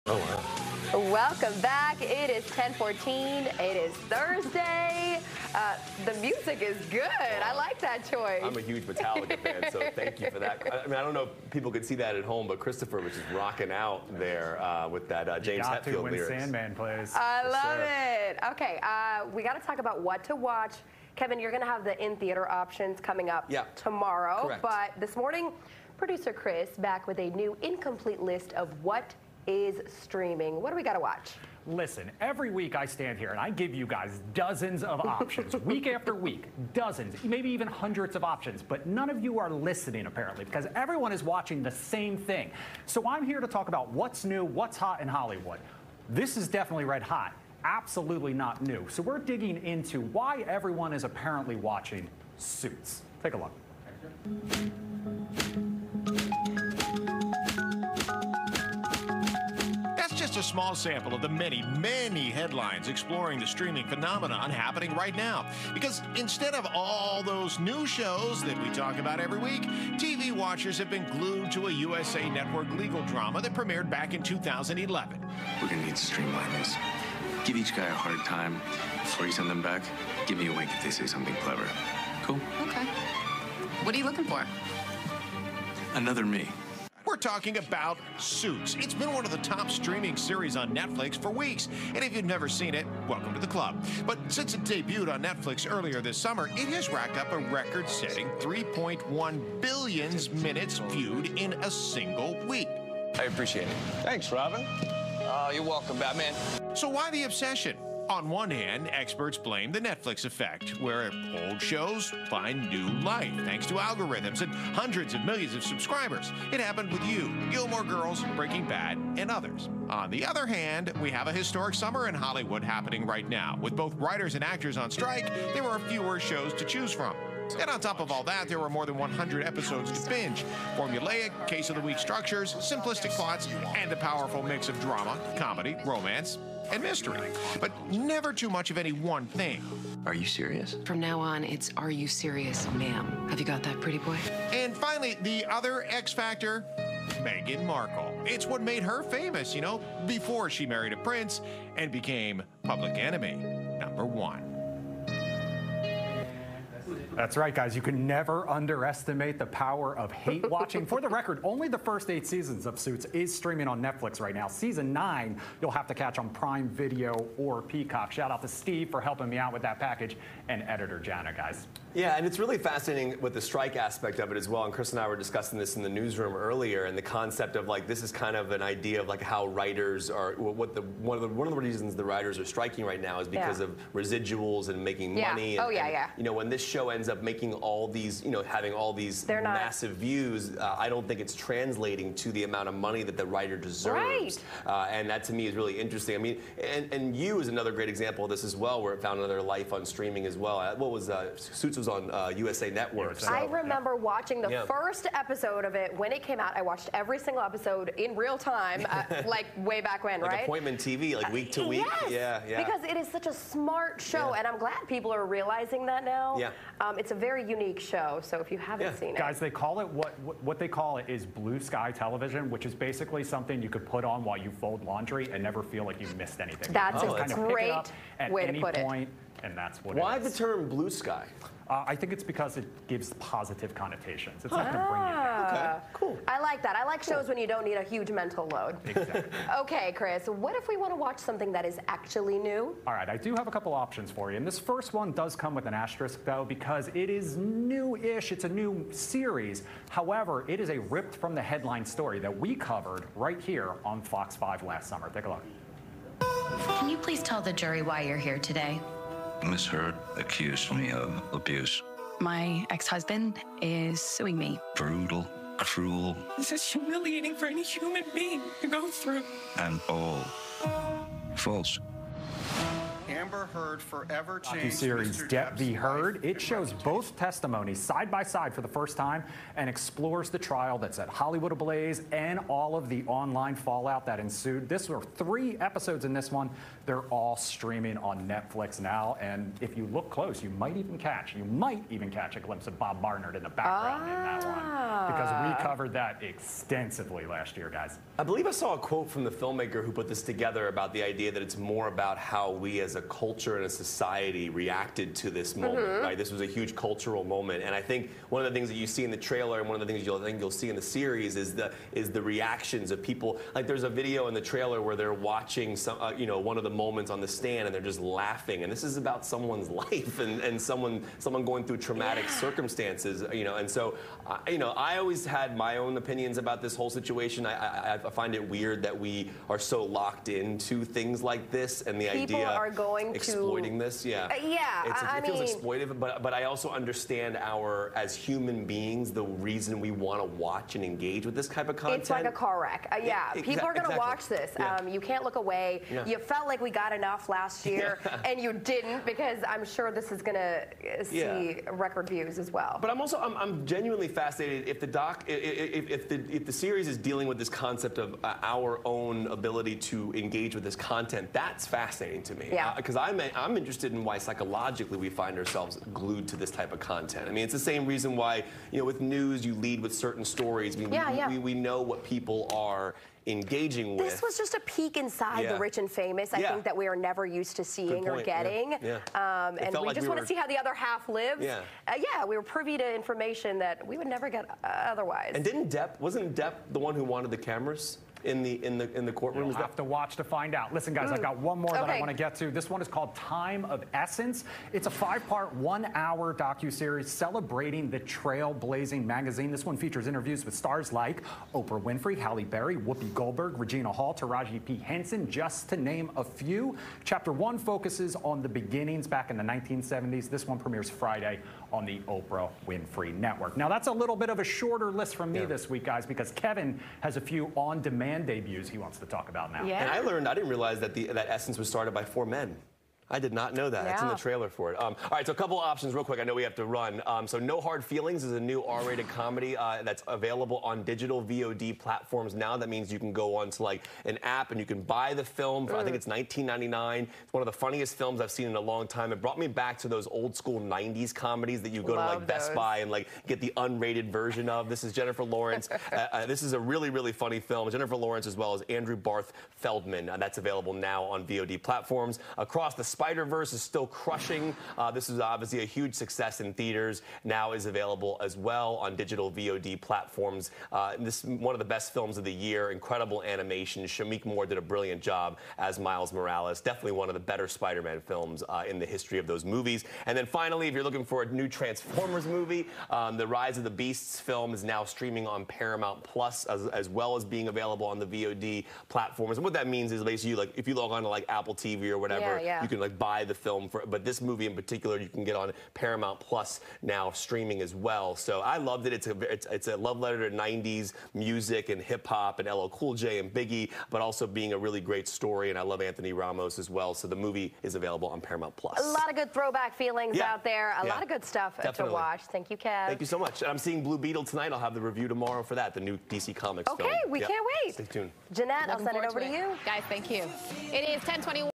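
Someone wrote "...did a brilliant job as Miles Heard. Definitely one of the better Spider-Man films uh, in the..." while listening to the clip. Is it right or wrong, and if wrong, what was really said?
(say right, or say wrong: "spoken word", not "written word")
wrong: "Morales", not "Heard".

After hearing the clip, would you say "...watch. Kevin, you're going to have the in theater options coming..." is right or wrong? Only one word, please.
right.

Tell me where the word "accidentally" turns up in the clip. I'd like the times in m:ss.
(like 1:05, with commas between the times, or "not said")
not said.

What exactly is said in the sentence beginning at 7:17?
It's one of the funniest films I've seen in a long time.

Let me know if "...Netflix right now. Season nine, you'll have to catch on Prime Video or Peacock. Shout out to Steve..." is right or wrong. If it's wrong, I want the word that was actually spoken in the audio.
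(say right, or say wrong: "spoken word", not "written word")
right.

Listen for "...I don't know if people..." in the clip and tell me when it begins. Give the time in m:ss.
0:10.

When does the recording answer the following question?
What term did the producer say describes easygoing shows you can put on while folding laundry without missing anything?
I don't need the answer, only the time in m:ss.
3:41.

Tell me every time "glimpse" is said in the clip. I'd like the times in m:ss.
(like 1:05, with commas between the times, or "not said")
4:52.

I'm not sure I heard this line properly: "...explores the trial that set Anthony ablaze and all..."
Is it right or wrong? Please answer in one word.
wrong.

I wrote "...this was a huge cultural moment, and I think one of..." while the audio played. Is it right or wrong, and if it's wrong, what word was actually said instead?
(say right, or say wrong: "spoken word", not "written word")
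right.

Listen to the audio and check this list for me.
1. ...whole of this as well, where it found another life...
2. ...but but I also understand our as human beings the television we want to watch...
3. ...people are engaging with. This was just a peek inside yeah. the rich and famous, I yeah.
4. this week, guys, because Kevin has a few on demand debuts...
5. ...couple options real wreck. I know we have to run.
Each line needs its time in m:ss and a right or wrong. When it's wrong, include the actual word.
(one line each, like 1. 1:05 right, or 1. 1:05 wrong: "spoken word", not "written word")
1. 3:17 wrong: "example", not "whole"
2. 5:35 wrong: "reason", not "television"
3. 6:12 right
4. 6:55 right
5. 7:05 wrong: "quick", not "wreck".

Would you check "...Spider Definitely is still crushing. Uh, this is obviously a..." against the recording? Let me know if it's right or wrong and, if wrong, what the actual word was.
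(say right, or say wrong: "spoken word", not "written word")
wrong: "Verse", not "Definitely".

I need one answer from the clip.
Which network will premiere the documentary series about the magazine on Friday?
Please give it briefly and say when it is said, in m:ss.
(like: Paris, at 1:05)
Oprah Winfrey Network, at 6:52.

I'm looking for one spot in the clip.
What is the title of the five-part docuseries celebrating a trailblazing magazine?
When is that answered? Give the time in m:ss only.
6:33.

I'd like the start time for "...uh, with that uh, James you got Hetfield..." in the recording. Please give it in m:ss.
0:14.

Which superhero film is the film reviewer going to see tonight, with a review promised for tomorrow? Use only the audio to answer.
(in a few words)
Blue Beetle.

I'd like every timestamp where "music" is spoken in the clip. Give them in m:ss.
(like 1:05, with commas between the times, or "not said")
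0:06, 8:11.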